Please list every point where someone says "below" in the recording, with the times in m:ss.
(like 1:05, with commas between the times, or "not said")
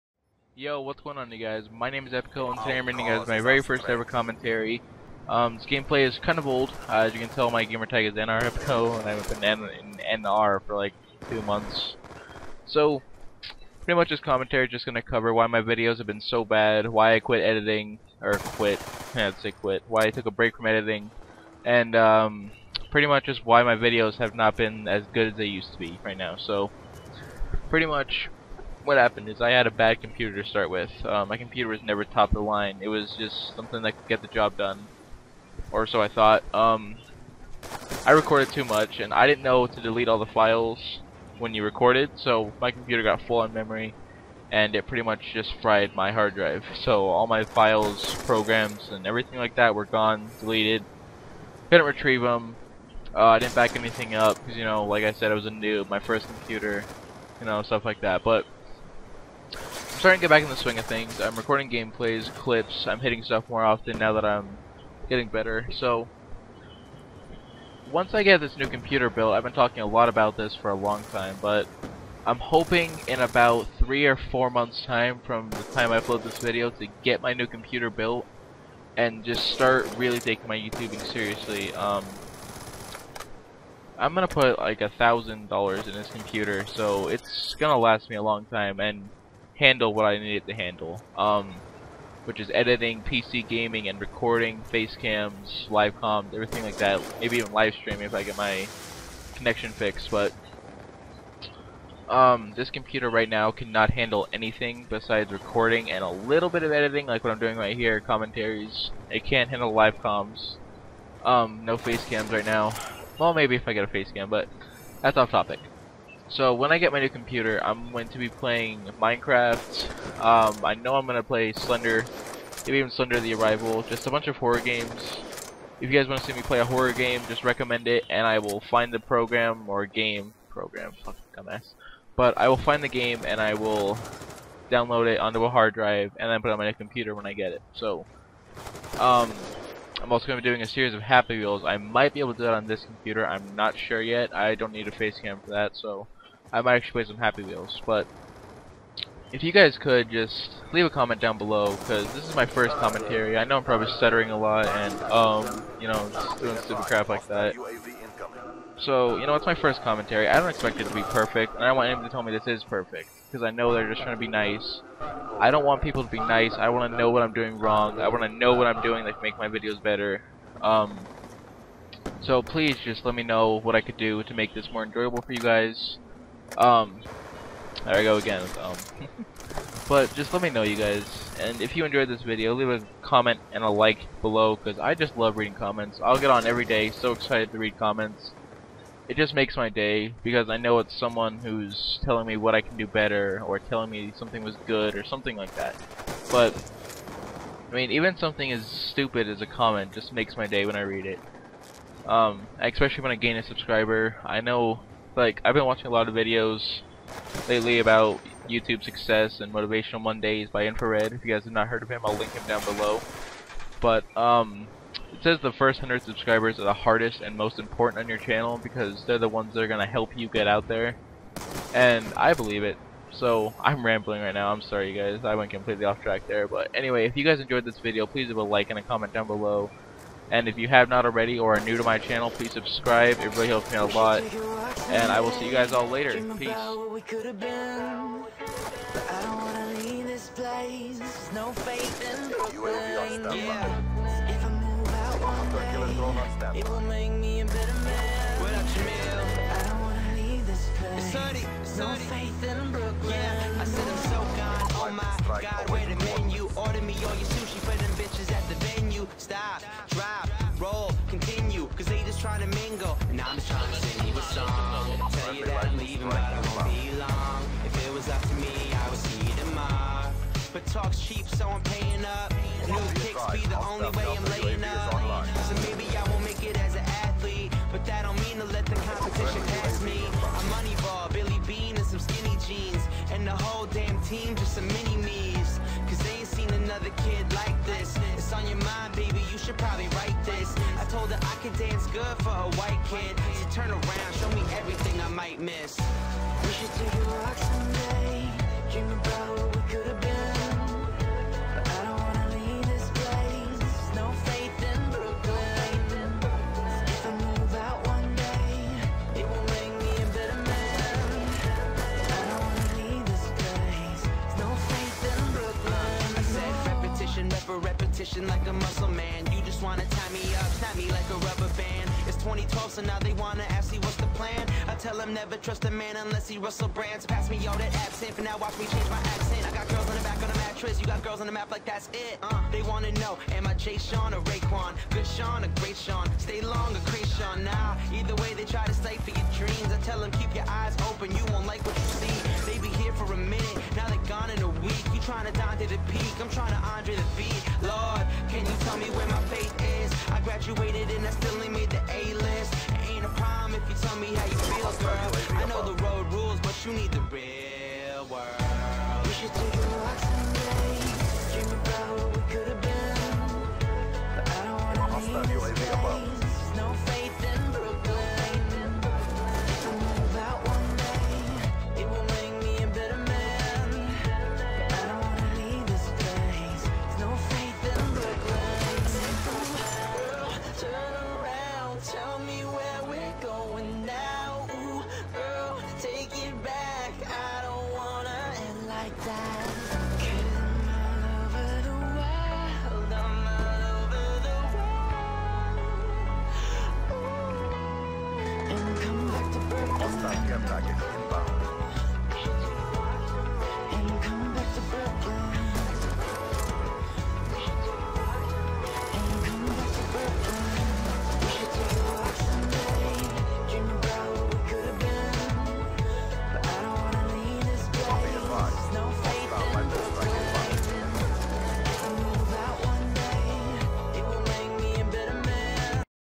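2:31, 3:04, 3:32, 3:49.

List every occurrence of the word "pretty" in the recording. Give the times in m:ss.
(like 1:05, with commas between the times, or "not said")
0:13, 0:22, 0:27, 0:44.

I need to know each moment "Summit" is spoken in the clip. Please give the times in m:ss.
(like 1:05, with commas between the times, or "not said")
not said.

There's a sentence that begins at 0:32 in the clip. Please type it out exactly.
It was just something that could get the job done, or so I thought.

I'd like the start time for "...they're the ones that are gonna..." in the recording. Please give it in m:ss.
3:39.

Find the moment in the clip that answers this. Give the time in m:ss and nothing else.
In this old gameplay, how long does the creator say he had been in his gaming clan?
0:11.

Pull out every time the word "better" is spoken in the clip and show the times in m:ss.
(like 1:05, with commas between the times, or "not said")
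1:05, 2:49, 3:12.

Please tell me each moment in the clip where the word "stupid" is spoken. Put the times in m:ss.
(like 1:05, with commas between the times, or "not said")
2:36, 3:18.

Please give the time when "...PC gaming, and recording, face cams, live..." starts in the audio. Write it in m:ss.
1:33.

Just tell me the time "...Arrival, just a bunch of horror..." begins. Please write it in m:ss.
2:03.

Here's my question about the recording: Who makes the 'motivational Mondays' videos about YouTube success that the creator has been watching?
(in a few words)
Infrared.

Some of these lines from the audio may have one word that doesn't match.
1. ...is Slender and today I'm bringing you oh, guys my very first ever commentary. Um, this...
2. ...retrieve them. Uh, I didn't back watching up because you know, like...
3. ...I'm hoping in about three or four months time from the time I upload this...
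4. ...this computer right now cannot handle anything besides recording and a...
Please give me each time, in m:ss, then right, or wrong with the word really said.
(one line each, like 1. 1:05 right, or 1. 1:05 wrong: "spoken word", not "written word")
1. 0:02 wrong: "Epico", not "Slender"
2. 0:51 wrong: "anything", not "watching"
3. 1:12 right
4. 1:42 right.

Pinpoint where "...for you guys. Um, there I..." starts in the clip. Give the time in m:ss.
2:55.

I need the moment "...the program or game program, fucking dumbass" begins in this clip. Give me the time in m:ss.
2:08.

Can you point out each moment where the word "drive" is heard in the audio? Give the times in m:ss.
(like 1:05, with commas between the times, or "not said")
0:46, 2:15.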